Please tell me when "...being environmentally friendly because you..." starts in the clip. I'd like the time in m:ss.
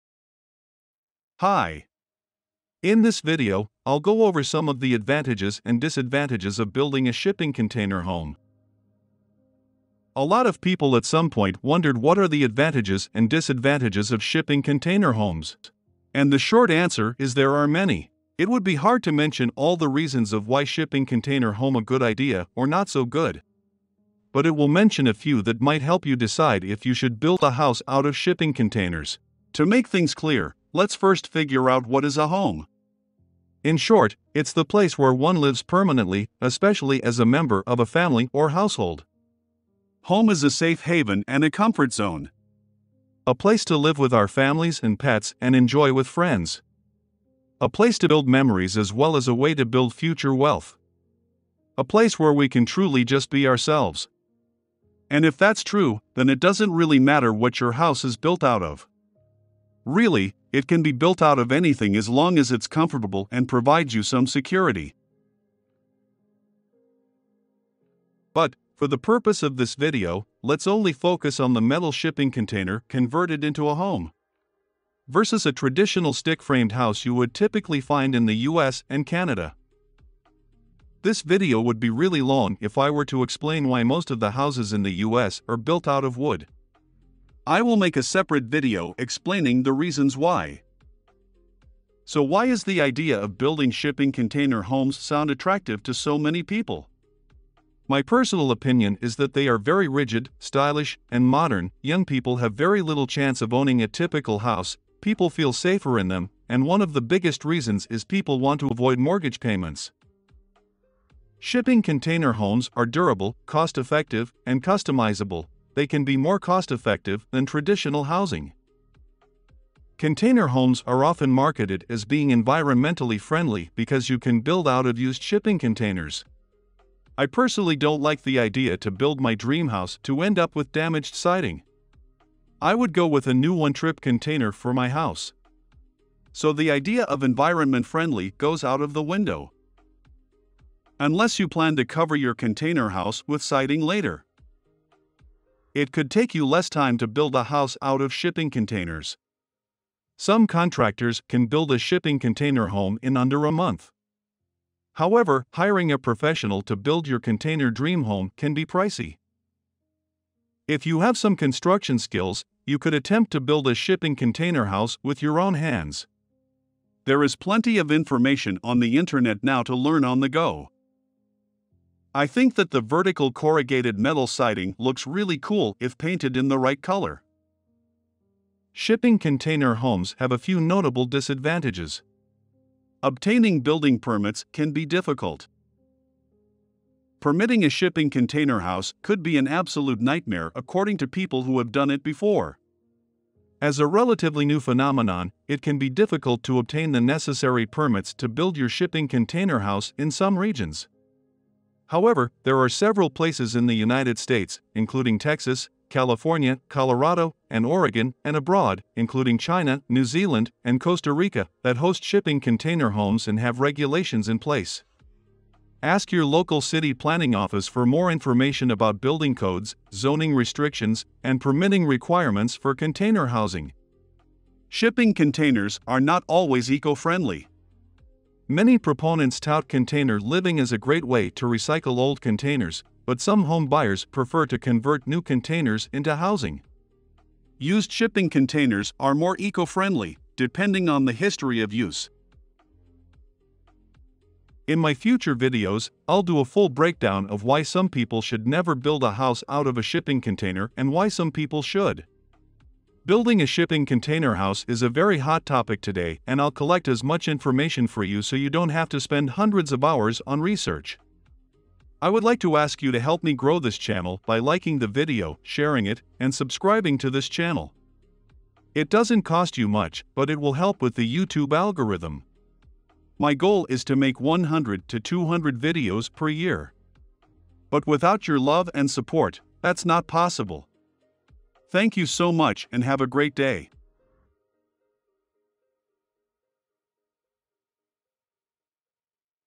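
2:02.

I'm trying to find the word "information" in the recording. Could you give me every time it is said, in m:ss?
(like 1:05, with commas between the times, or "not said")
2:47, 3:38, 4:17.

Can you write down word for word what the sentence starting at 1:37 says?
My personal opinion is that they are very rigid, stylish, and modern.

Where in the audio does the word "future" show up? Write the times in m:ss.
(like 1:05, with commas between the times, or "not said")
0:49, 4:04.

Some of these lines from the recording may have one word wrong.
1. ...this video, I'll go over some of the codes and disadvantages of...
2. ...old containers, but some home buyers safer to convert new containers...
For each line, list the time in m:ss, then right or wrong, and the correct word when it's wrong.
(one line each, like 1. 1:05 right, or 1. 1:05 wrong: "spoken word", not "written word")
1. 0:03 wrong: "advantages", not "codes"
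2. 3:51 wrong: "prefer", not "safer".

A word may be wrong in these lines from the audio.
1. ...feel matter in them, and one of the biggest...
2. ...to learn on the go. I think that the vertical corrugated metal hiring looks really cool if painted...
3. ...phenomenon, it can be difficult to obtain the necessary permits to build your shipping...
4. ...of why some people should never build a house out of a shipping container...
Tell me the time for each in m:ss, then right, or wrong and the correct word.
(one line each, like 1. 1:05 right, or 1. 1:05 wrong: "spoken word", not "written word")
1. 1:45 wrong: "safer", not "matter"
2. 2:49 wrong: "siding", not "hiring"
3. 3:14 right
4. 4:07 right.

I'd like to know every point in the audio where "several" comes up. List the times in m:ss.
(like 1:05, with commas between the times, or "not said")
3:22.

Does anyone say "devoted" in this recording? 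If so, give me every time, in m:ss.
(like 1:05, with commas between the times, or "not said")
not said.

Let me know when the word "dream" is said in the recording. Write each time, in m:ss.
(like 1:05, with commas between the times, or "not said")
2:09, 2:37.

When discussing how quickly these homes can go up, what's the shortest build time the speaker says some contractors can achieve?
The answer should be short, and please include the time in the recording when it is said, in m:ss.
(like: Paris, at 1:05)
under a month, at 2:33.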